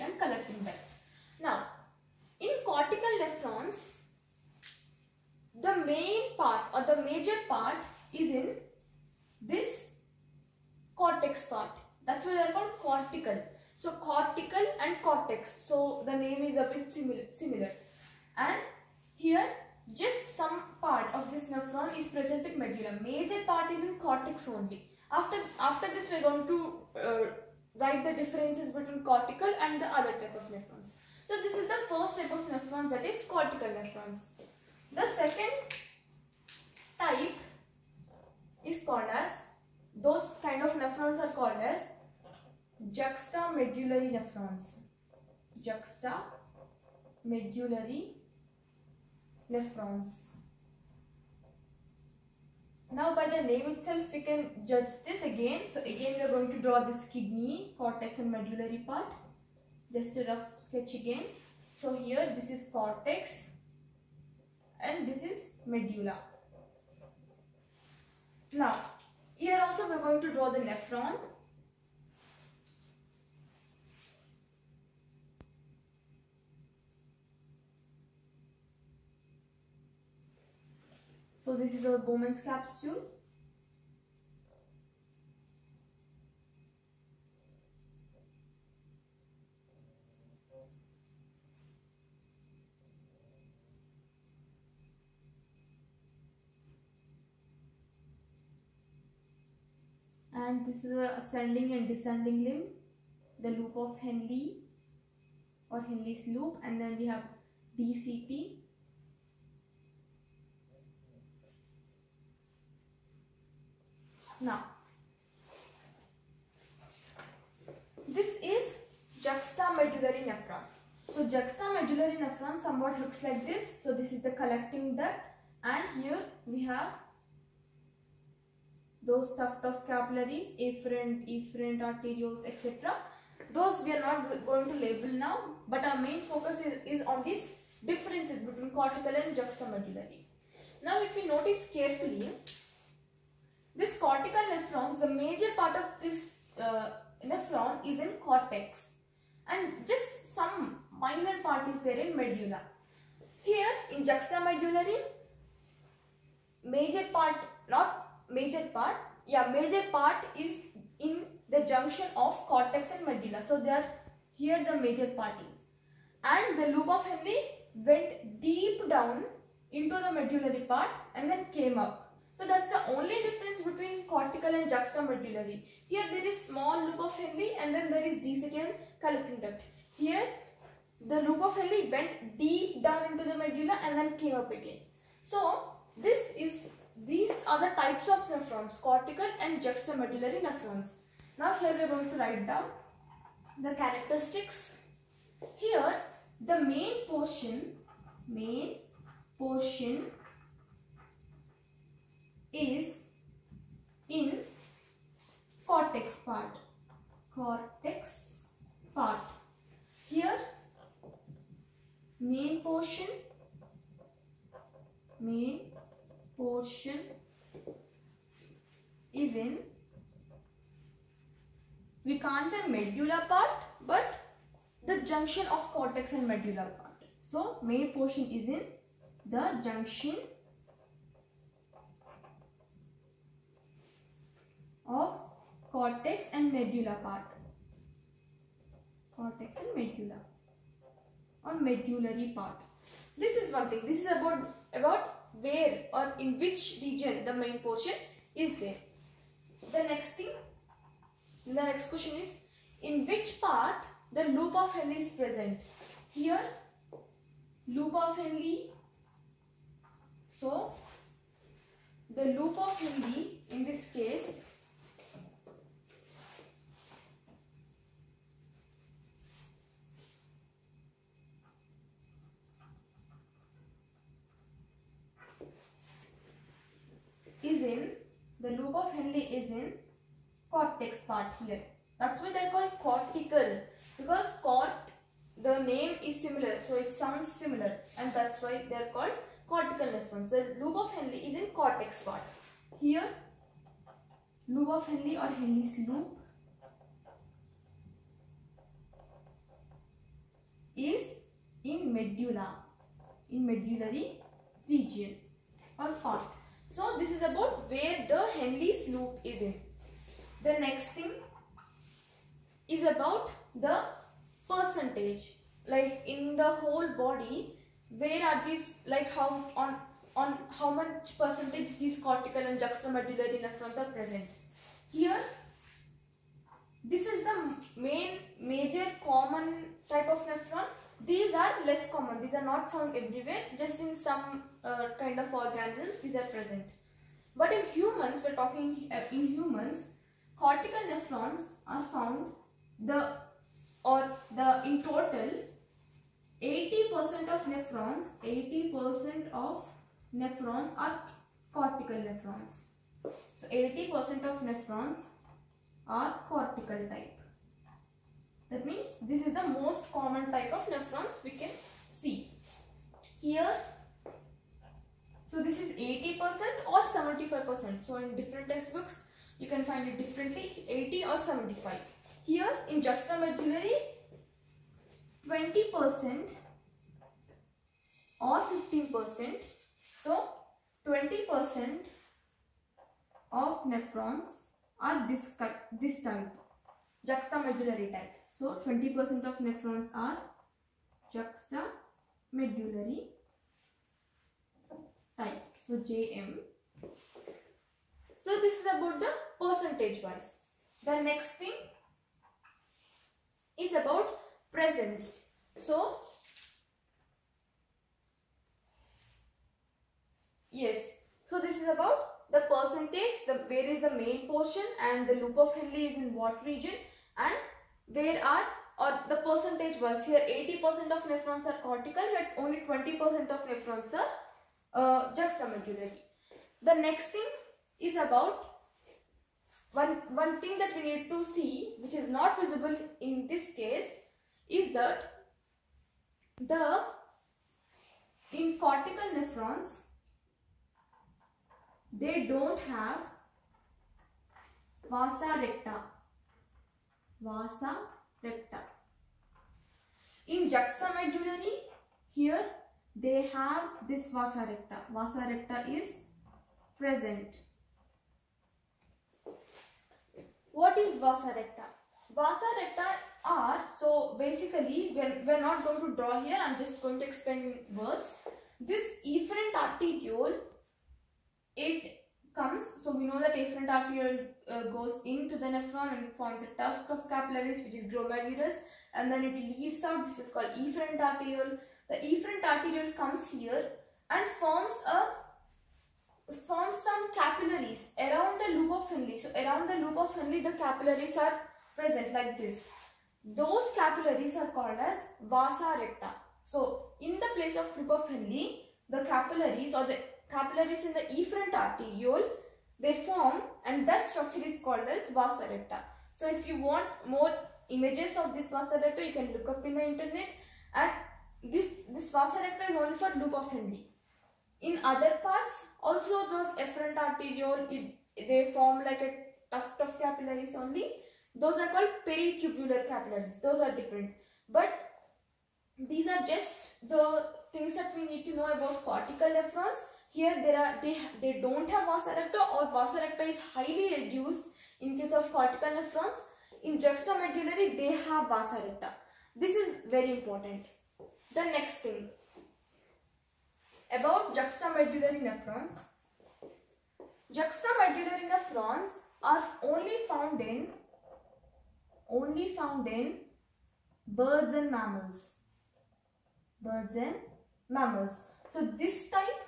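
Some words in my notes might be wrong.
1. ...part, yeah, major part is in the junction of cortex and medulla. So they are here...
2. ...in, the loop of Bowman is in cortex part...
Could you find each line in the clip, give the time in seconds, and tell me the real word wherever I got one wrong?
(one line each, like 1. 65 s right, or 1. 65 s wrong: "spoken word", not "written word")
1. 158 s right
2. 277 s wrong: "Henle", not "Bowman".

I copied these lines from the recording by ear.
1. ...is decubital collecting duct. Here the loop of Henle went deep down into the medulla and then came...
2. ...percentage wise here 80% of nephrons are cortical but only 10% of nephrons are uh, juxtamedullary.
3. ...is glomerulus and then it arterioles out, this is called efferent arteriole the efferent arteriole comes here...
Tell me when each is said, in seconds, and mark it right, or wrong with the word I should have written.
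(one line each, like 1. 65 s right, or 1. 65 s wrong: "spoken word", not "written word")
1. 178 s right
2. 419 s wrong: "20", not "10"
3. 477 s wrong: "leaves", not "arterioles".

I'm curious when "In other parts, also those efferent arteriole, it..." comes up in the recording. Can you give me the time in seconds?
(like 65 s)
514 s.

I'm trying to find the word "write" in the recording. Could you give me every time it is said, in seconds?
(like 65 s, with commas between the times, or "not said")
27 s, 192 s.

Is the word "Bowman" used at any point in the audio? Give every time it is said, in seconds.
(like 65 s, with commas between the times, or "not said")
81 s.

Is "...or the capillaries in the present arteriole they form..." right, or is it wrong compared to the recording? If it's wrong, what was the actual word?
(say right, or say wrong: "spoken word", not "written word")
wrong: "efferent", not "present".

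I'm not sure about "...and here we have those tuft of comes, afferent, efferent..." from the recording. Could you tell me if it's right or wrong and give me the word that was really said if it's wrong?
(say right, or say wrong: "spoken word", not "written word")
wrong: "capillaries", not "comes".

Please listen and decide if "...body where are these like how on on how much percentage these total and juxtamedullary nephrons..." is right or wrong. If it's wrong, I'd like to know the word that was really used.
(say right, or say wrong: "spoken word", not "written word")
wrong: "cortical", not "total".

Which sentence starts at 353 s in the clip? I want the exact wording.
So 80% of nephrons are cortical type.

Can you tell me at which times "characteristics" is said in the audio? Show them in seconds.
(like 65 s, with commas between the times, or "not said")
193 s.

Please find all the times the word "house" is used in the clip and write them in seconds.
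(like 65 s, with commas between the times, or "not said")
not said.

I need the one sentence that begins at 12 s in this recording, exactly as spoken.
That's why they are called cortical.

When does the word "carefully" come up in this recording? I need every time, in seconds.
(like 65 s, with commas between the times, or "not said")
141 s.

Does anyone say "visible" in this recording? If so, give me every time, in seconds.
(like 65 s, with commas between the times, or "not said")
432 s.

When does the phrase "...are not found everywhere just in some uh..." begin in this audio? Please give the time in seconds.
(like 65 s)
332 s.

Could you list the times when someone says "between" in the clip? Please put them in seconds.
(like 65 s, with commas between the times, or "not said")
28 s, 138 s, 173 s.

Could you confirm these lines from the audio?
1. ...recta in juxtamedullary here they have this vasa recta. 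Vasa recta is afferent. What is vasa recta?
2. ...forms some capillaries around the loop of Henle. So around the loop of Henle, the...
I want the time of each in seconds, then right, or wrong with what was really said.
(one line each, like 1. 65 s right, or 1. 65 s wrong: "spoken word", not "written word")
1. 448 s wrong: "present", not "afferent"
2. 486 s right.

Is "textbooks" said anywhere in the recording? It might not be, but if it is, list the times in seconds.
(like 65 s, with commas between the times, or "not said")
368 s.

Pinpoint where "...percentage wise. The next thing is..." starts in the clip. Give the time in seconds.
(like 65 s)
399 s.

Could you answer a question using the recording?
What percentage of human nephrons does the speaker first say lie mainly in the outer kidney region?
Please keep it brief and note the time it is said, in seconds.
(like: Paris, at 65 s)
80%, at 346 s.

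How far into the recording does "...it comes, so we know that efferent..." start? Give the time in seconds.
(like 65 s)
471 s.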